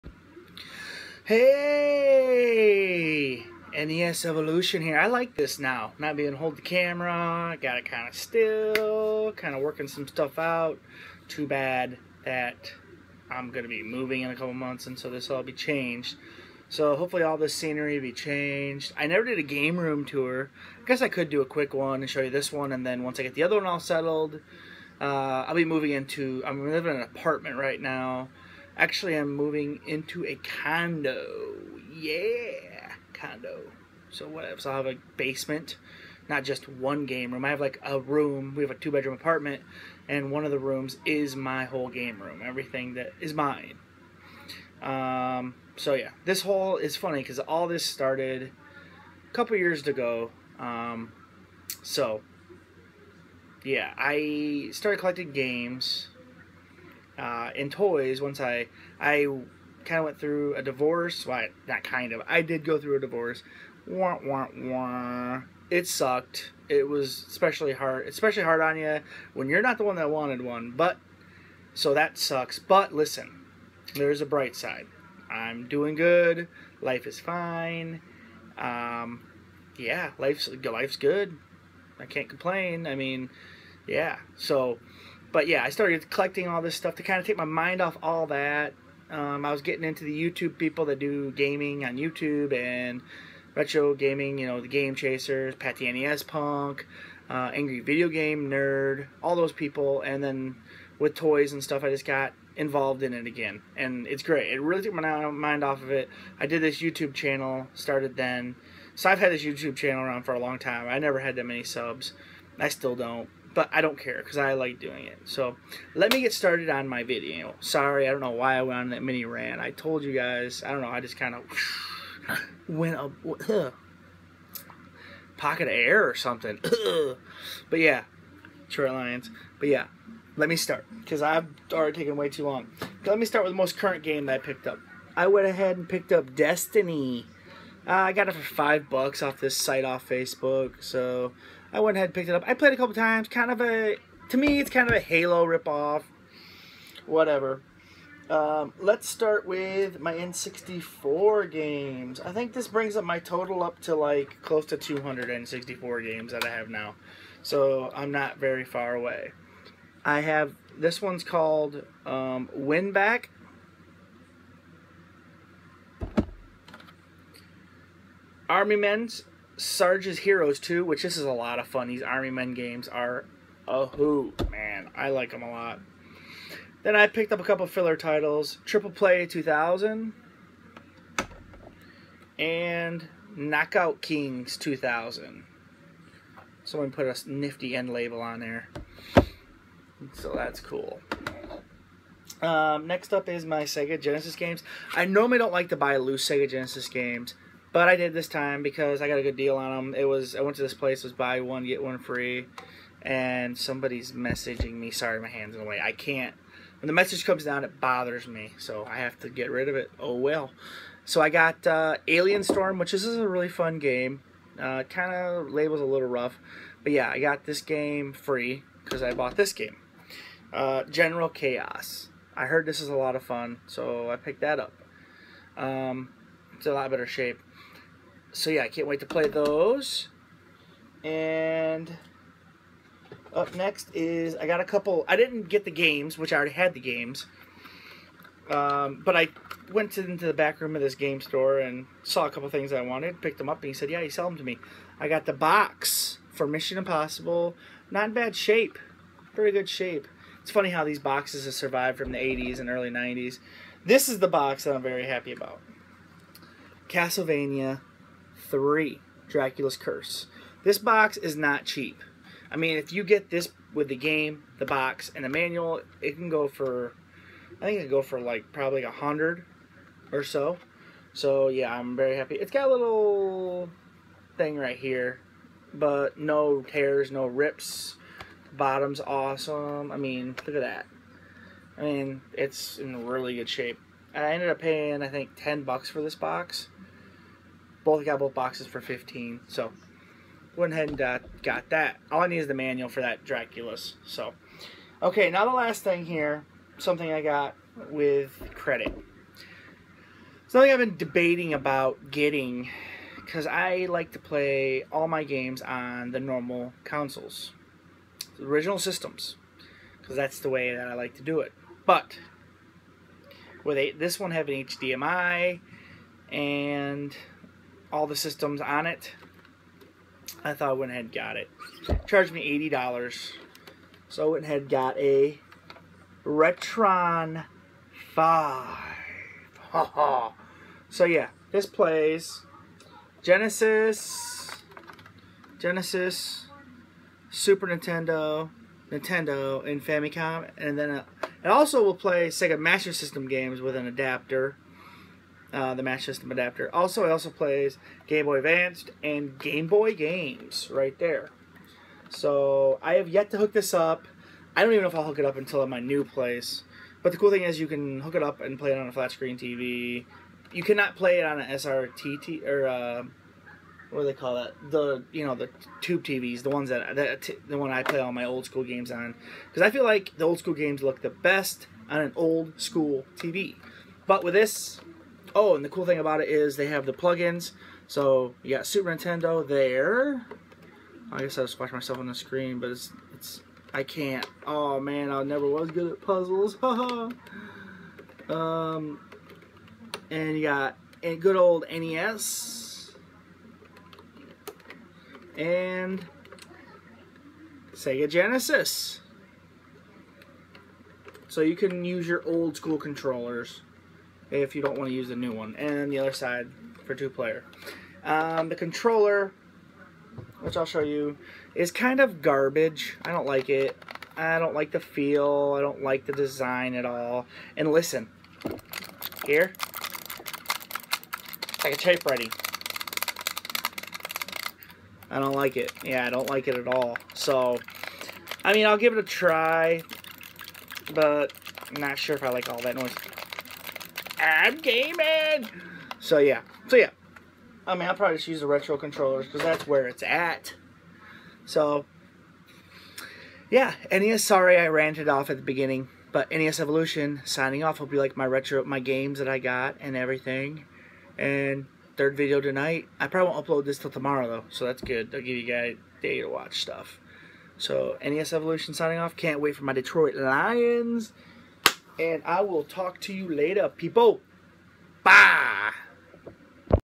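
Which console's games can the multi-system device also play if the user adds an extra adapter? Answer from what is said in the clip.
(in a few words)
Sega Master System.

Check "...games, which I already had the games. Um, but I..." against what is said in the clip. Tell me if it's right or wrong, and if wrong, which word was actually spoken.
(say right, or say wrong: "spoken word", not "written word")
right.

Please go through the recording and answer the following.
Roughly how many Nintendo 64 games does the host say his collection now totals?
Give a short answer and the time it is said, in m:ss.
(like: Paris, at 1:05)
close to 200, at 2:34.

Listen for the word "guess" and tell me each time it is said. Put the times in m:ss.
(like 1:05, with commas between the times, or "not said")
0:20, 6:21.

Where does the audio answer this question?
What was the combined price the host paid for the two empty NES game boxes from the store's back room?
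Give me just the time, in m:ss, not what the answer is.
4:48.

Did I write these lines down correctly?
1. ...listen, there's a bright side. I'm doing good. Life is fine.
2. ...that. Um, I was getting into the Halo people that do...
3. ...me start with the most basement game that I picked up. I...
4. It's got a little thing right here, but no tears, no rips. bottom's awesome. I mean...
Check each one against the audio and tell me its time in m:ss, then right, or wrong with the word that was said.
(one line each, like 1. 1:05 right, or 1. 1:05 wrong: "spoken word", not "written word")
1. 1:12 right
2. 1:28 wrong: "YouTube", not "Halo"
3. 2:13 wrong: "current", not "basement"
4. 4:32 right.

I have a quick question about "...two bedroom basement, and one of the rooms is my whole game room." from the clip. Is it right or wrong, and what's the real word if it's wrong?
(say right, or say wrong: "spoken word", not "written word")
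wrong: "apartment", not "basement".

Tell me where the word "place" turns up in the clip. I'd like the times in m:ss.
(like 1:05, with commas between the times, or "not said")
3:20, 5:56.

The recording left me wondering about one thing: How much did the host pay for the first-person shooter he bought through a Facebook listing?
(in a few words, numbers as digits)
5 bucks.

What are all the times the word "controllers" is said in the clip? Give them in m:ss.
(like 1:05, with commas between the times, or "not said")
6:42, 6:48, 7:18.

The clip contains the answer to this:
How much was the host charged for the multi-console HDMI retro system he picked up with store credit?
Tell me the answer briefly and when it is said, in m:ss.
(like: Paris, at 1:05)
$80, at 5:22.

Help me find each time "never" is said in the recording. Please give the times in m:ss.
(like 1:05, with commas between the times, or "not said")
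0:19, 1:50, 6:25.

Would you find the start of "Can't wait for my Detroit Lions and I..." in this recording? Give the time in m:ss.
7:39.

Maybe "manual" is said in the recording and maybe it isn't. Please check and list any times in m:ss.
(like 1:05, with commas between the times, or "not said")
4:25, 4:52.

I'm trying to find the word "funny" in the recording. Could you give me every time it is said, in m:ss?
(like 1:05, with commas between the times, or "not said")
0:46, 4:10.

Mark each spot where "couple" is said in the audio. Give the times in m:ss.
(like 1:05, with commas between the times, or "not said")
0:14, 0:49, 2:22, 2:57, 3:54, 4:02.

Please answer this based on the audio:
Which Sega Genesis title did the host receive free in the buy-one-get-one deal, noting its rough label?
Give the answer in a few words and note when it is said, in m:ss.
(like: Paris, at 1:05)
Alien Storm, at 3:32.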